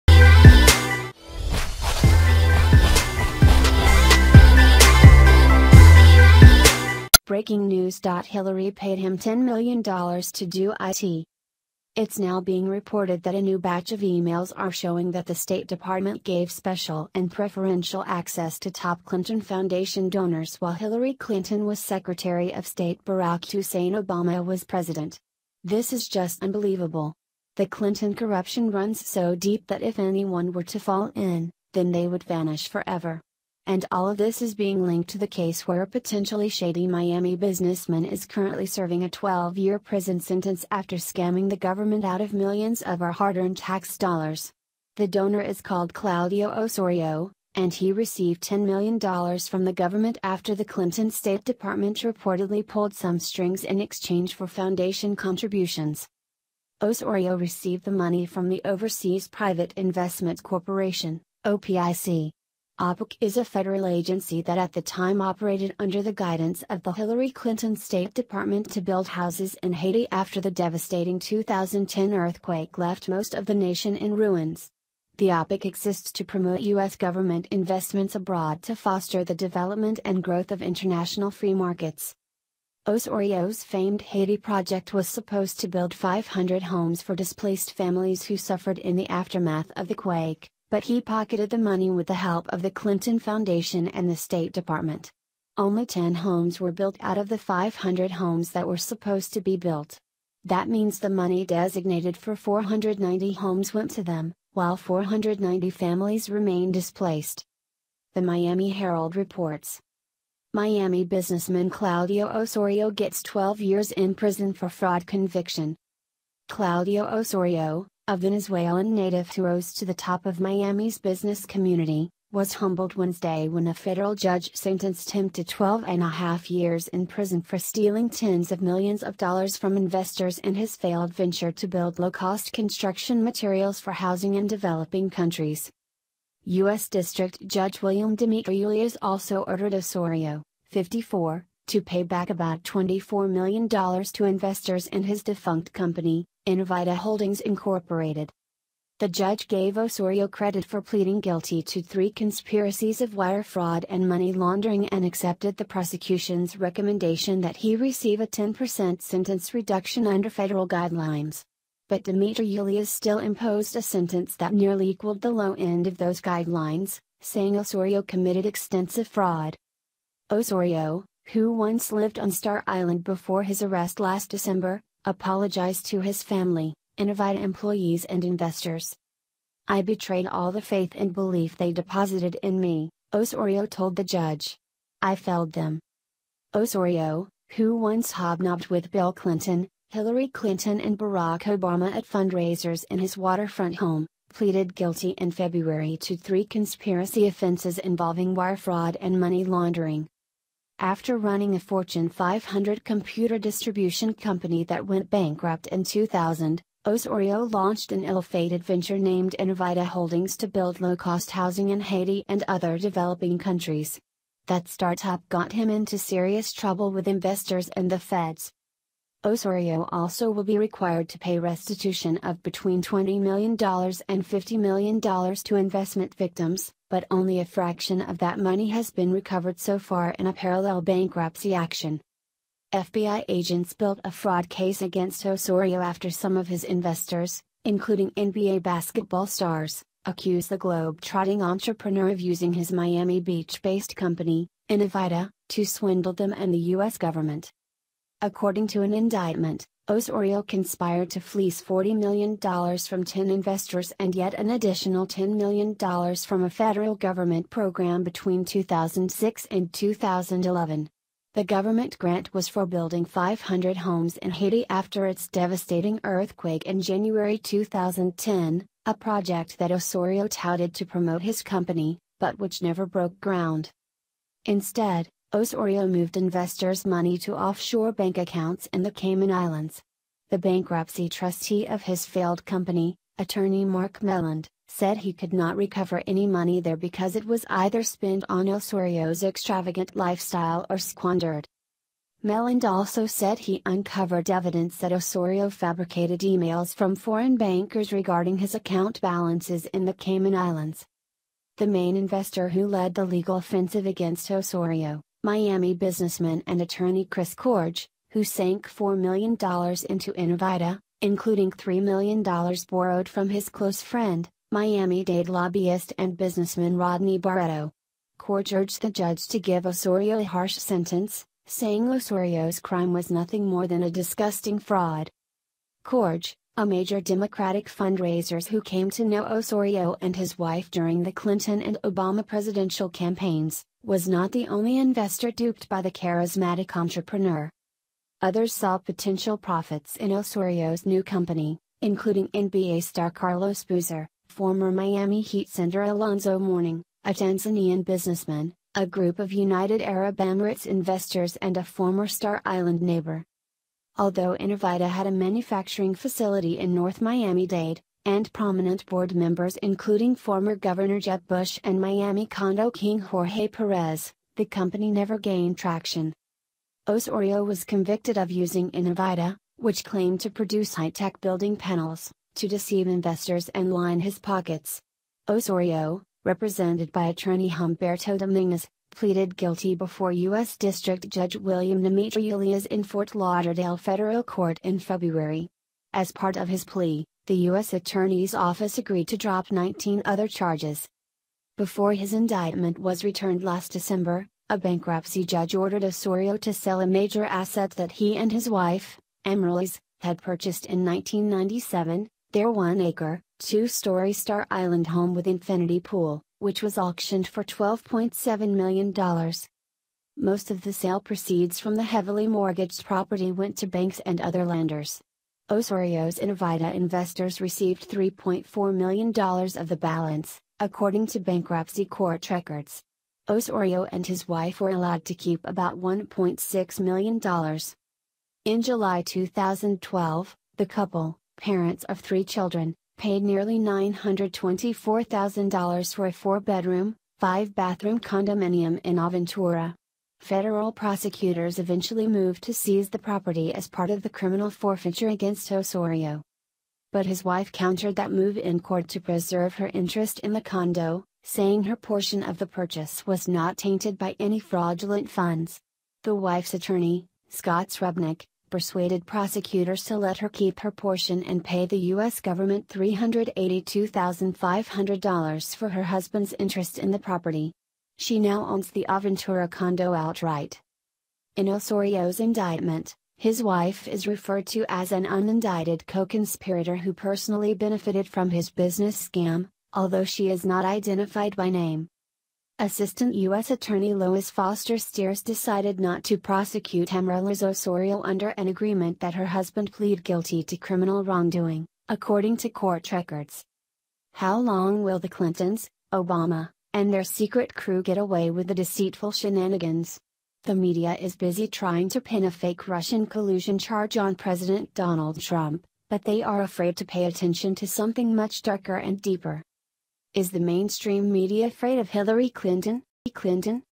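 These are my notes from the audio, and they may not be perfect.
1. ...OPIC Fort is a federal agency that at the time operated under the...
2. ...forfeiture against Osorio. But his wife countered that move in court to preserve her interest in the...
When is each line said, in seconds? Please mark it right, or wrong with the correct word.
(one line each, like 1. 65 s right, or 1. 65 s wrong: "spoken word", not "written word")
1. 61 s wrong: "OPIC", not "Fort"
2. 444 s right.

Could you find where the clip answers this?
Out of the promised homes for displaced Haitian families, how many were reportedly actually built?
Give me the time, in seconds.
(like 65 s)
95 s.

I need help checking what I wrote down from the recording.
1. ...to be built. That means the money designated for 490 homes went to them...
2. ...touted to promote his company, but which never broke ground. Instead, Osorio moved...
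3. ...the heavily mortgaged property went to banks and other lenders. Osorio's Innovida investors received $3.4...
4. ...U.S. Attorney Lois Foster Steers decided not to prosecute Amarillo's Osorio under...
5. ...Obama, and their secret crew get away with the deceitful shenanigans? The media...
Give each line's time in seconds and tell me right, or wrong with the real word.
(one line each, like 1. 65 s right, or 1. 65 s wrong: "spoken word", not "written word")
1. 99 s right
2. 270 s right
3. 411 s right
4. 483 s right
5. 495 s right.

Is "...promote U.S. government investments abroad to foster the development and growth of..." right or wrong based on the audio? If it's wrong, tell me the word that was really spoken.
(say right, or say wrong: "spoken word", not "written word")
right.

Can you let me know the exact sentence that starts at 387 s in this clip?
Attorney's Office agreed to drop 19 other charges.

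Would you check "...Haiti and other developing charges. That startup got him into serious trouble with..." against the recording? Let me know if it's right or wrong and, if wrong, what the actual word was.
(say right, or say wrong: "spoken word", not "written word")
wrong: "countries", not "charges".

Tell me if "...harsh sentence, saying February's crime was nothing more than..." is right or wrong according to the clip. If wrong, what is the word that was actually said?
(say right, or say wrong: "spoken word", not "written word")
wrong: "Osorio", not "February".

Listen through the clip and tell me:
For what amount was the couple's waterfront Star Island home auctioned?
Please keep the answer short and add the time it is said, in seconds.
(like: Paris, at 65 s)
$12.7 million, at 407 s.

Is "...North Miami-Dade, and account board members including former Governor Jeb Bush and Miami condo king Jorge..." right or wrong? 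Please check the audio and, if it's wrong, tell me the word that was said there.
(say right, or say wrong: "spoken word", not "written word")
wrong: "prominent", not "account".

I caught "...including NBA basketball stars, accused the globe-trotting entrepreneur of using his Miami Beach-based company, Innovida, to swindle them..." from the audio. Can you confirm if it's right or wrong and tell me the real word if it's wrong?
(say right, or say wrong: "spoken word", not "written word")
right.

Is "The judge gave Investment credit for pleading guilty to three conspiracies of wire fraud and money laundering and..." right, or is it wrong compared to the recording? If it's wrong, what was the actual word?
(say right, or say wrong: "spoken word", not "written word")
wrong: "Osorio", not "Investment".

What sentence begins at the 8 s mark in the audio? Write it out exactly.
Hillary paid him $10 million to do IT.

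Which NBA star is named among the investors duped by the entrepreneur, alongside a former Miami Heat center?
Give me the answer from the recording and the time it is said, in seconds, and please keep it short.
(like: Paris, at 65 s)
Carlos Boozer, at 343 s.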